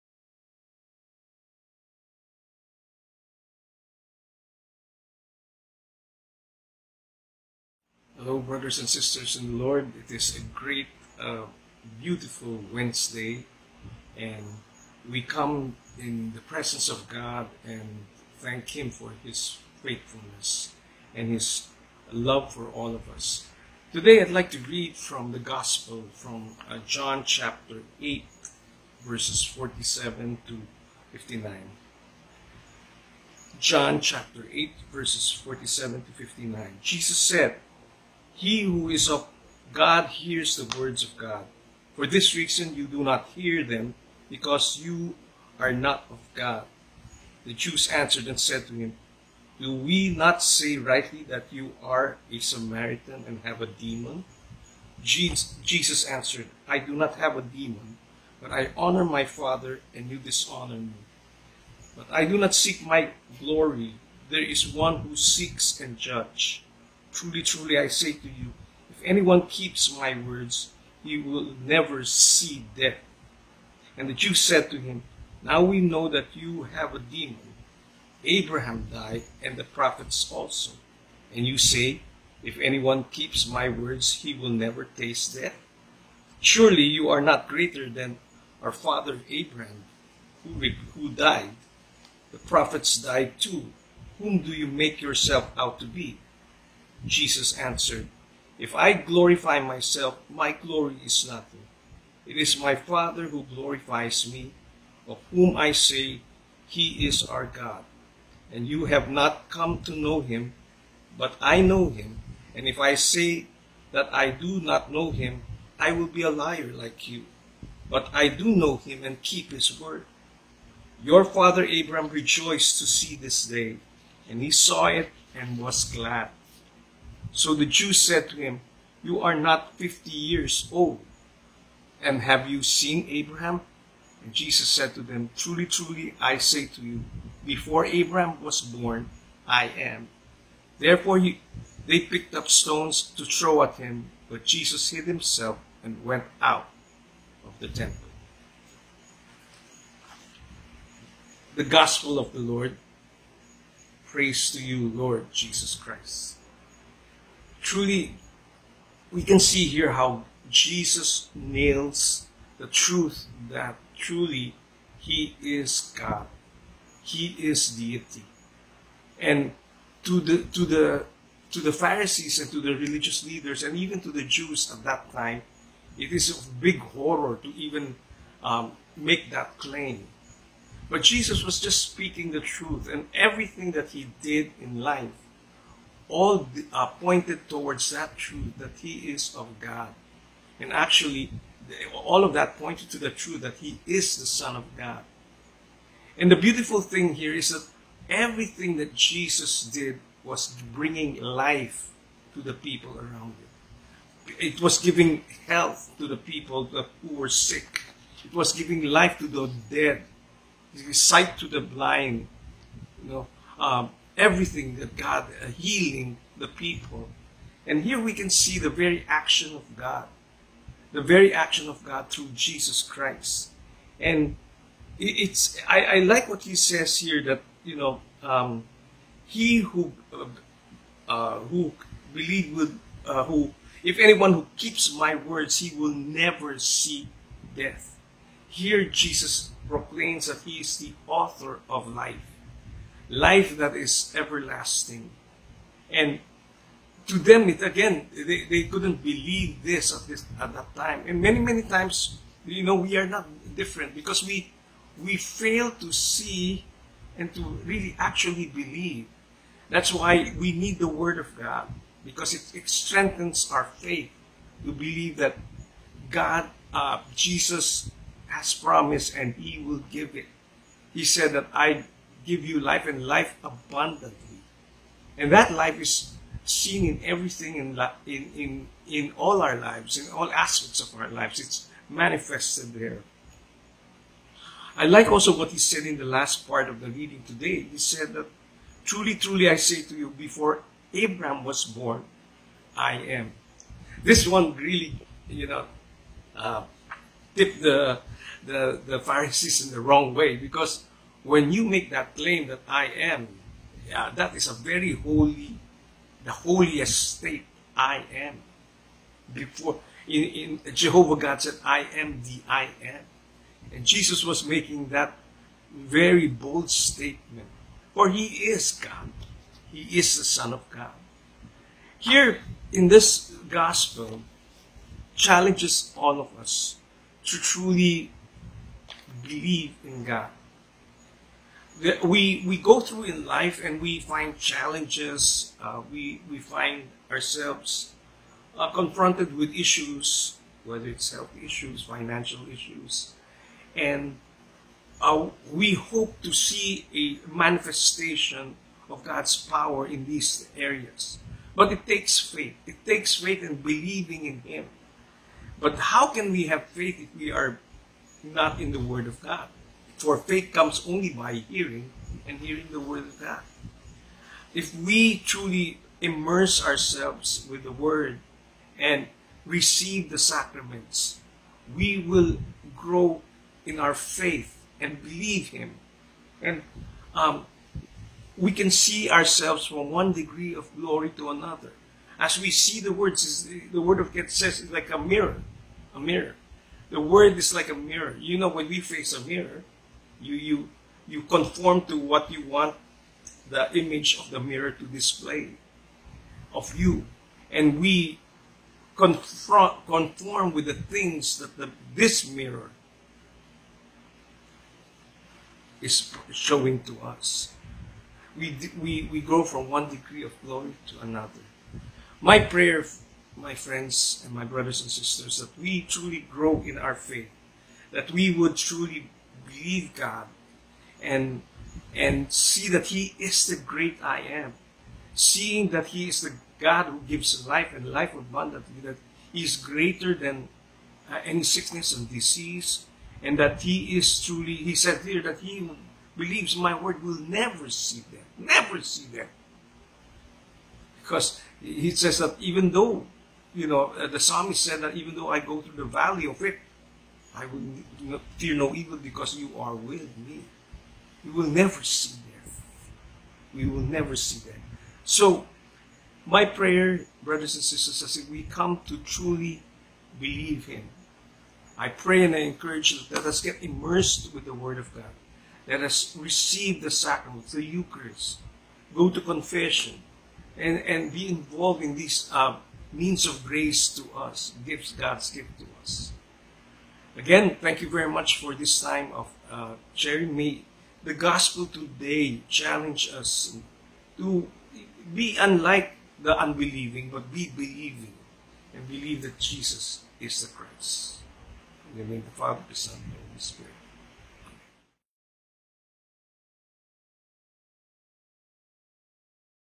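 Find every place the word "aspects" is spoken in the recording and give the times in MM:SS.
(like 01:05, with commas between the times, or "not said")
04:40.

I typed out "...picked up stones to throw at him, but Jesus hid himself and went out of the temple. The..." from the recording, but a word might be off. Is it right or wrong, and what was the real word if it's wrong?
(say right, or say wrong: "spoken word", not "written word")
right.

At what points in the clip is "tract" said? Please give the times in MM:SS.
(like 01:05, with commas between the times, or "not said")
not said.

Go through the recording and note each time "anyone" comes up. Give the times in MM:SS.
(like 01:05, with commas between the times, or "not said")
01:09, 01:22, 03:53.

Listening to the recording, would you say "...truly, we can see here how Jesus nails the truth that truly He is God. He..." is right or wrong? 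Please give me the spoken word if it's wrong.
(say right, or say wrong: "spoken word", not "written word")
right.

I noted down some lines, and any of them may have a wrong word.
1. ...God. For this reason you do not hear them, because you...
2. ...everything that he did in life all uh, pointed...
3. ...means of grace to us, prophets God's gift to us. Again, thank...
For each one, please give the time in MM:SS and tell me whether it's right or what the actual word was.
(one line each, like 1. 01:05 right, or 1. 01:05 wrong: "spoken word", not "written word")
1. 00:41 right
2. 03:03 right
3. 07:52 wrong: "gifts", not "prophets".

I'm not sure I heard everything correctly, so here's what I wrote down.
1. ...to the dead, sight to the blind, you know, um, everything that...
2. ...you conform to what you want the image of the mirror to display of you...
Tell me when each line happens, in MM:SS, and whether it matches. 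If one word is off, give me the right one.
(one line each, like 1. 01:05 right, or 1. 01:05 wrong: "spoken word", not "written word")
1. 03:29 right
2. 06:31 right.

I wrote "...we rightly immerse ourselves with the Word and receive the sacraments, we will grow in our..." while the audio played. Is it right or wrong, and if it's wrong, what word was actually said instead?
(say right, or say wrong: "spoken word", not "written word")
wrong: "truly", not "rightly".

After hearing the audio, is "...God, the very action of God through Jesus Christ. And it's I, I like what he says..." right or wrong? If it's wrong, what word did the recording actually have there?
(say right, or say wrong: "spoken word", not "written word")
right.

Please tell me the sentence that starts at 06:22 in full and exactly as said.
As we see the words, the Word of God says it's like a mirror, a mirror.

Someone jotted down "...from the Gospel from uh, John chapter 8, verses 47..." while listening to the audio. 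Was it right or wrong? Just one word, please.
right.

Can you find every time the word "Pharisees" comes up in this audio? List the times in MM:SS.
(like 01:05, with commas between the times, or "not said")
02:51, 04:58.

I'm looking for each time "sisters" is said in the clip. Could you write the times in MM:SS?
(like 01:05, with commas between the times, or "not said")
00:08, 06:54, 07:37.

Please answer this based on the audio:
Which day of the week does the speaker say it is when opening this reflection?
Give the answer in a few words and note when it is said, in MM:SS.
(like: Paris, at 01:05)
Wednesday, at 00:12.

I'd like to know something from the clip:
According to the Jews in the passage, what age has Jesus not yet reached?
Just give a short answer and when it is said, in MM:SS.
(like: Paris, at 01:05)
50, at 02:09.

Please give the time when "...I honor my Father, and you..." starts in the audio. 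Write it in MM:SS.
00:58.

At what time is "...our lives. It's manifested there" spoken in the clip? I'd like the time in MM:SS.
04:40.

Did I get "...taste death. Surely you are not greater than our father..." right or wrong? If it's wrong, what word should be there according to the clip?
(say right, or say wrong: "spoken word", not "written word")
right.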